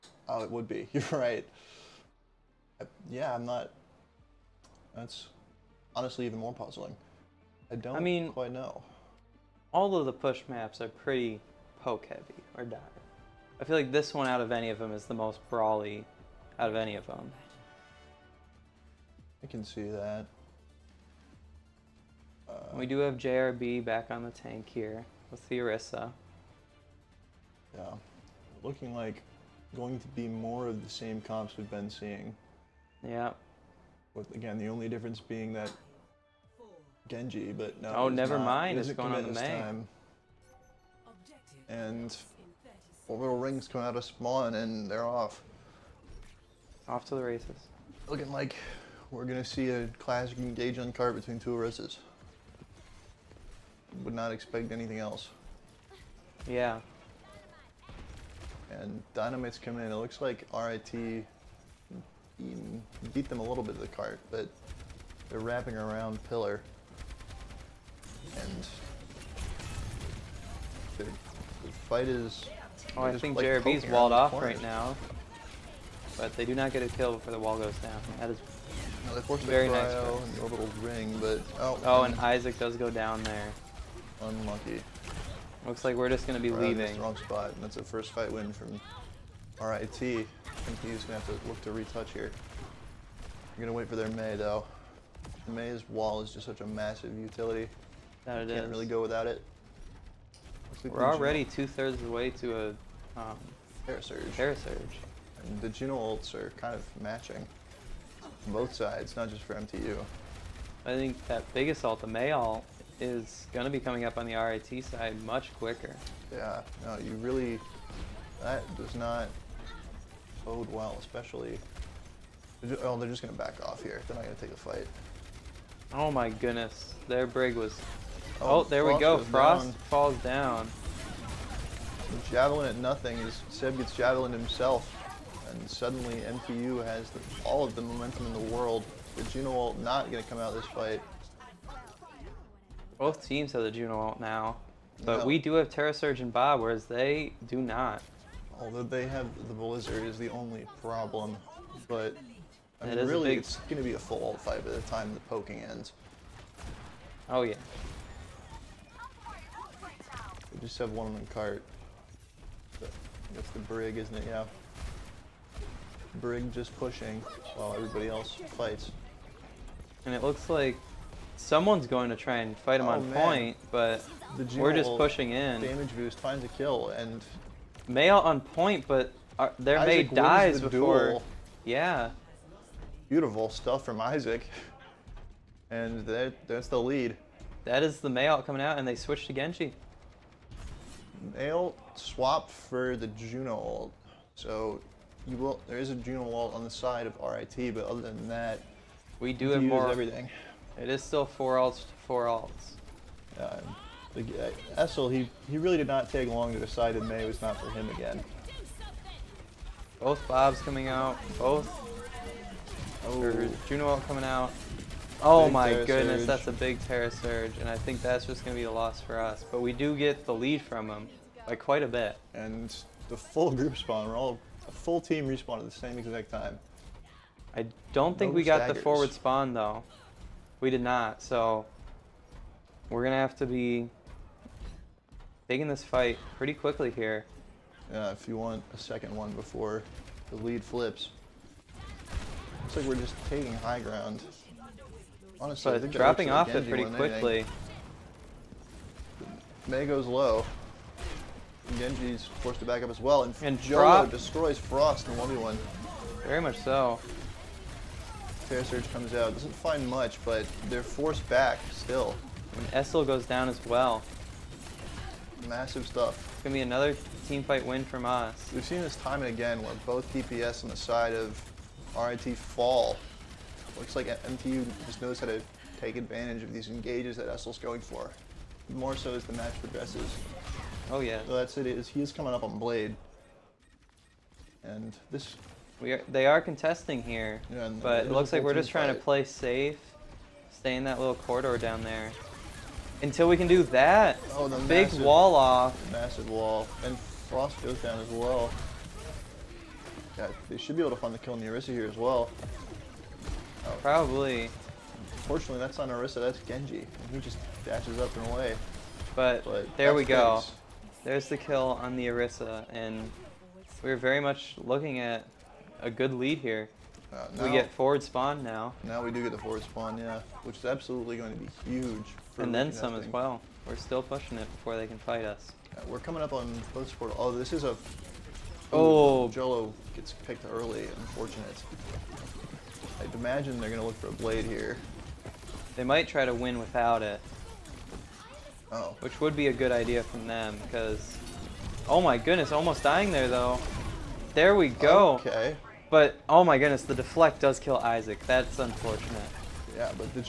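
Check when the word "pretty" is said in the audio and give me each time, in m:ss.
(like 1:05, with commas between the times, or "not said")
0:10, 3:56, 4:06.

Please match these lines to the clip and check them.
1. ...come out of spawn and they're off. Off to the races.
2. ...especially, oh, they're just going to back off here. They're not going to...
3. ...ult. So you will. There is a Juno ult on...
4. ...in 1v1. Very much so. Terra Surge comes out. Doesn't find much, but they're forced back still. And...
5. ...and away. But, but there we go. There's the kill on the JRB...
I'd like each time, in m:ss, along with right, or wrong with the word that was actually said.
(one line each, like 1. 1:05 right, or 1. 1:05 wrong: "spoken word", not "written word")
1. 0:43 right
2. 2:00 right
3. 3:13 right
4. 4:15 right
5. 5:08 wrong: "Orisa", not "JRB".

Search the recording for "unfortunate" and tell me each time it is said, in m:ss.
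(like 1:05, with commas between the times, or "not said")
5:30, 5:48.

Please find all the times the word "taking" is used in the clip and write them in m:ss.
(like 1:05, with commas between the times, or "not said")
3:55, 4:03.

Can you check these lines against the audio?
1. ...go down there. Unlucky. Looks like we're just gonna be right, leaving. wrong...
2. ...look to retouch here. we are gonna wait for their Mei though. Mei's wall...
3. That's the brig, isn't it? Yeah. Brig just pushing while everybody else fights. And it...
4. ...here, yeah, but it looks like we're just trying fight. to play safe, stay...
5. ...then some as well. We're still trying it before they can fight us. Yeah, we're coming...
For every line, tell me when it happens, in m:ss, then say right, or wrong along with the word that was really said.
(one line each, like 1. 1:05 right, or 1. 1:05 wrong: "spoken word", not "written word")
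1. 1:22 right
2. 1:31 right
3. 2:43 right
4. 4:47 right
5. 5:22 wrong: "pushing", not "trying".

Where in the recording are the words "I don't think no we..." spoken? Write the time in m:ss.
3:47.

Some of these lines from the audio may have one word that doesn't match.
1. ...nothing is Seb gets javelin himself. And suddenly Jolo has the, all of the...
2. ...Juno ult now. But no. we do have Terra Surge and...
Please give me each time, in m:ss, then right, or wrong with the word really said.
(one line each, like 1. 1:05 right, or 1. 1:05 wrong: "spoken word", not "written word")
1. 2:12 wrong: "MTU", not "Jolo"
2. 2:23 right.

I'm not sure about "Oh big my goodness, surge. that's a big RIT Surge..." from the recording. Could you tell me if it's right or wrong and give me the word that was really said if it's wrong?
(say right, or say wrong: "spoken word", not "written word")
wrong: "Terra", not "RIT".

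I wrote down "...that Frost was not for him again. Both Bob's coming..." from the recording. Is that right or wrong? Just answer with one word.
wrong.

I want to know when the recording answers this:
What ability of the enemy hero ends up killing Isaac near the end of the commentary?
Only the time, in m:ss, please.
5:46.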